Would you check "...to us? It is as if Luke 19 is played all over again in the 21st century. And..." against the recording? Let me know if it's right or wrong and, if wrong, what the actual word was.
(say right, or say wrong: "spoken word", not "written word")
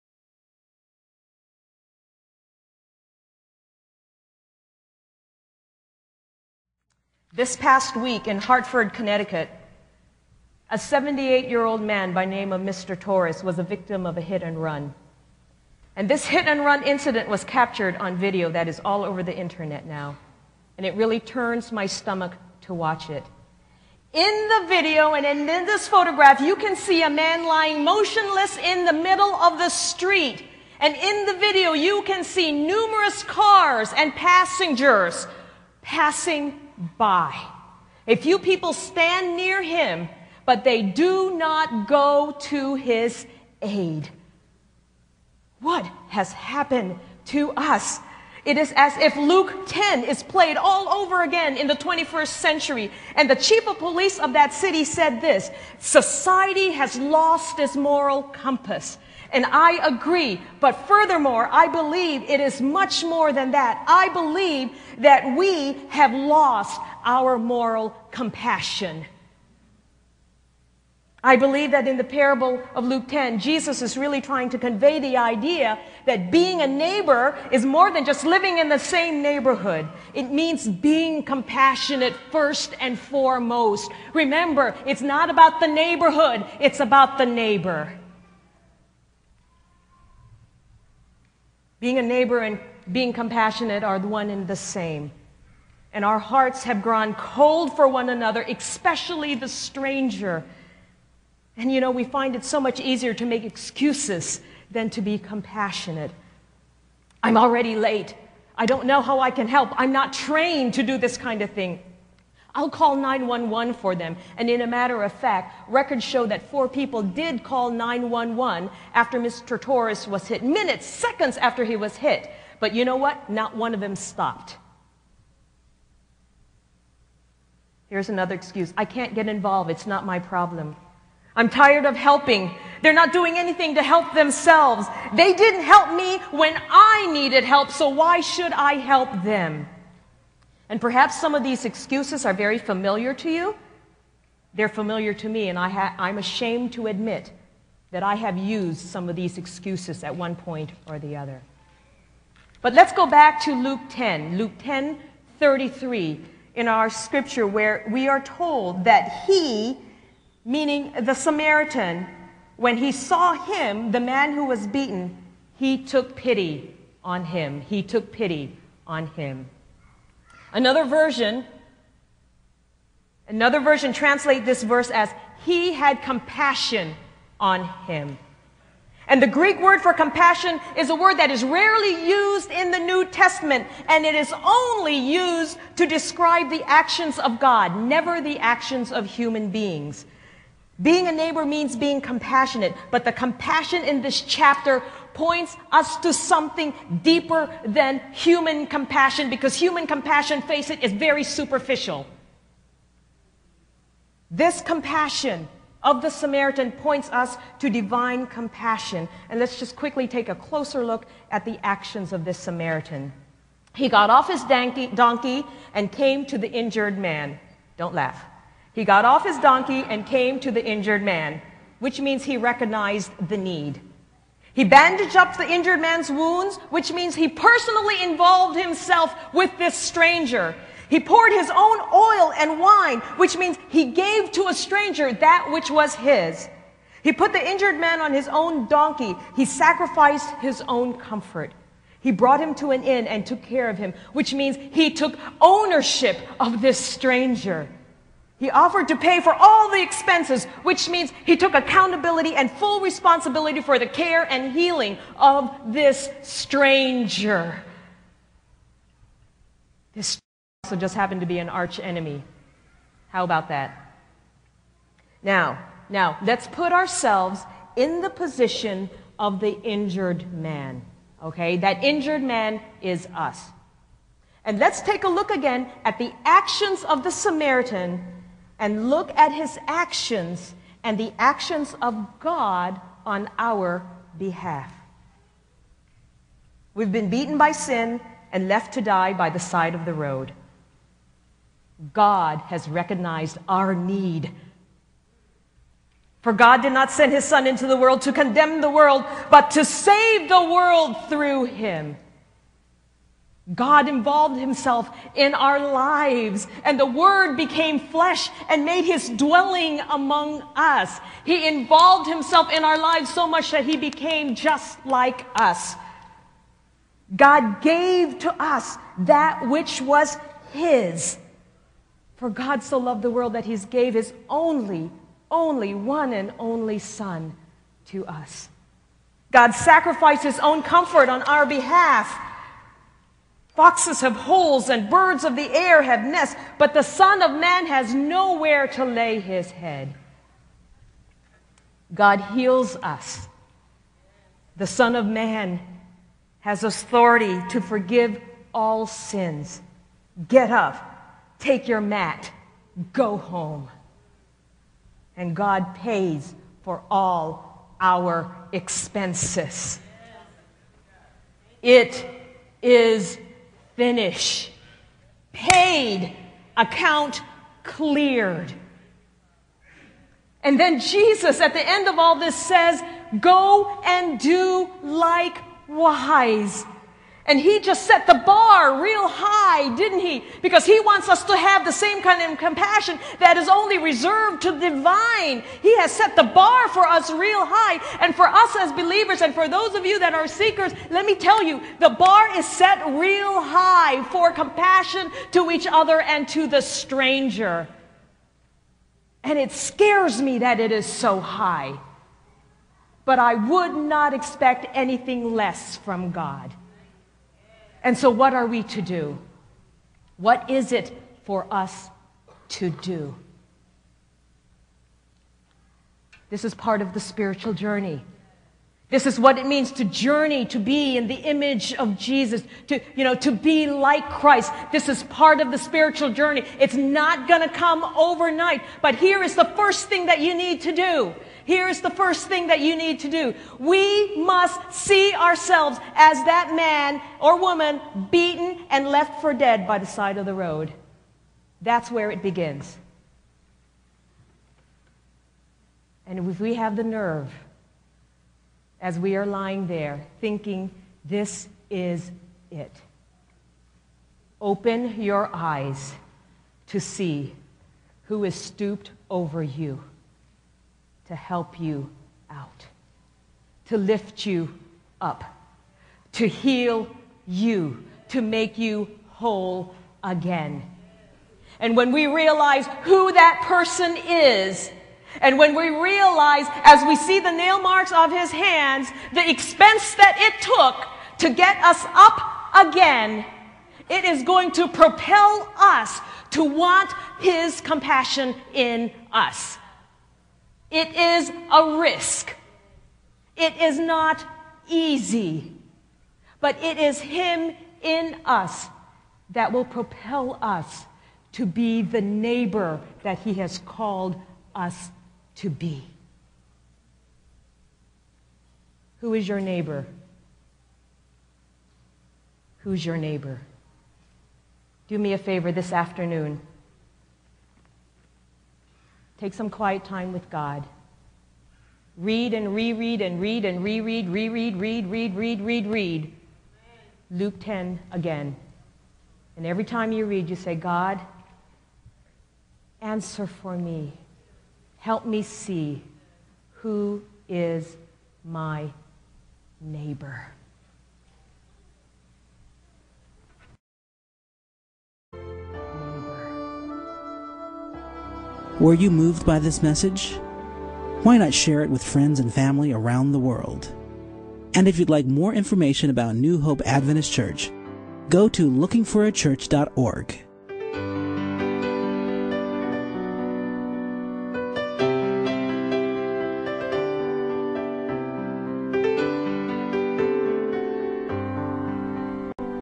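wrong: "10", not "19".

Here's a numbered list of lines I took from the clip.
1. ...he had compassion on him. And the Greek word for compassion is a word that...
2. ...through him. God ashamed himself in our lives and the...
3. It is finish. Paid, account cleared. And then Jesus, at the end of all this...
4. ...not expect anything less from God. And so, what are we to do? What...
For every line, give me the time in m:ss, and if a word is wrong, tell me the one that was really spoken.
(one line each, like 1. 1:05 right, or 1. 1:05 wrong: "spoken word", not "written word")
1. 2:55 right
2. 5:01 wrong: "involved", not "ashamed"
3. 6:01 right
4. 6:43 right.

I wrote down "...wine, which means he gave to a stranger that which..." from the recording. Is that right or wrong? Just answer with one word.
right.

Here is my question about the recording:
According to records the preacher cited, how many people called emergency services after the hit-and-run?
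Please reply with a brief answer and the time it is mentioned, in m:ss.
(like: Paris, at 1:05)
4, at 1:56.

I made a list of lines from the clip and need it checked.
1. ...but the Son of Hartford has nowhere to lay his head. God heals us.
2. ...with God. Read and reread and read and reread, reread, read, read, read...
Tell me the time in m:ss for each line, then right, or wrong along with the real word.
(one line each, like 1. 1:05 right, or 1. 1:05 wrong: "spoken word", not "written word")
1. 5:36 wrong: "Man", not "Hartford"
2. 8:40 right.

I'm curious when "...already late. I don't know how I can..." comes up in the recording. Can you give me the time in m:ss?
1:47.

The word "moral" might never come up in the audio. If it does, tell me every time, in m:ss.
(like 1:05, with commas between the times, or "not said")
0:57, 1:07.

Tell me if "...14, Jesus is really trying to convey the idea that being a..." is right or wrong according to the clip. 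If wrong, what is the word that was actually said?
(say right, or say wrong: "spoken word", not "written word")
wrong: "10", not "14".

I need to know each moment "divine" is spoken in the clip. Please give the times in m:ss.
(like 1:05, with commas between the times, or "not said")
3:27, 6:24.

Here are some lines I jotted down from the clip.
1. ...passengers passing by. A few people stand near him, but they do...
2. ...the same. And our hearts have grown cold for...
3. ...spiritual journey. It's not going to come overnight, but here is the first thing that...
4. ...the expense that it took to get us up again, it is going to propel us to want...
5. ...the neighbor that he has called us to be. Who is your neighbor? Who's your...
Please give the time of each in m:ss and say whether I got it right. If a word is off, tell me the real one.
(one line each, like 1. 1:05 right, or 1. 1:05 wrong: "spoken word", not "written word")
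1. 0:34 right
2. 1:34 right
3. 7:05 right
4. 7:59 right
5. 8:21 right.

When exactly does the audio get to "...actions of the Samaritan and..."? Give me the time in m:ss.
4:36.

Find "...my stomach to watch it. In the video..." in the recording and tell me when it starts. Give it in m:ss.
0:21.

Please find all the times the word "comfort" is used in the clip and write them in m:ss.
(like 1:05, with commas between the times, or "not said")
4:00, 5:30.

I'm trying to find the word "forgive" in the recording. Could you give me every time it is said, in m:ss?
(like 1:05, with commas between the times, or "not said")
5:47.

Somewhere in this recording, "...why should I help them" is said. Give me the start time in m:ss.
2:17.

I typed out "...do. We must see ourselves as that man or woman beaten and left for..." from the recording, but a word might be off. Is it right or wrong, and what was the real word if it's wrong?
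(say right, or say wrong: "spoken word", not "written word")
right.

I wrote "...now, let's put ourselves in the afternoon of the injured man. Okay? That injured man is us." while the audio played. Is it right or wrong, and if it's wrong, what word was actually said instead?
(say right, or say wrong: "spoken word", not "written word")
wrong: "position", not "afternoon".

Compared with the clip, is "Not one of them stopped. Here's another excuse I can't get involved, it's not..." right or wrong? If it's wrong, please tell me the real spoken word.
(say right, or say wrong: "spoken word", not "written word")
right.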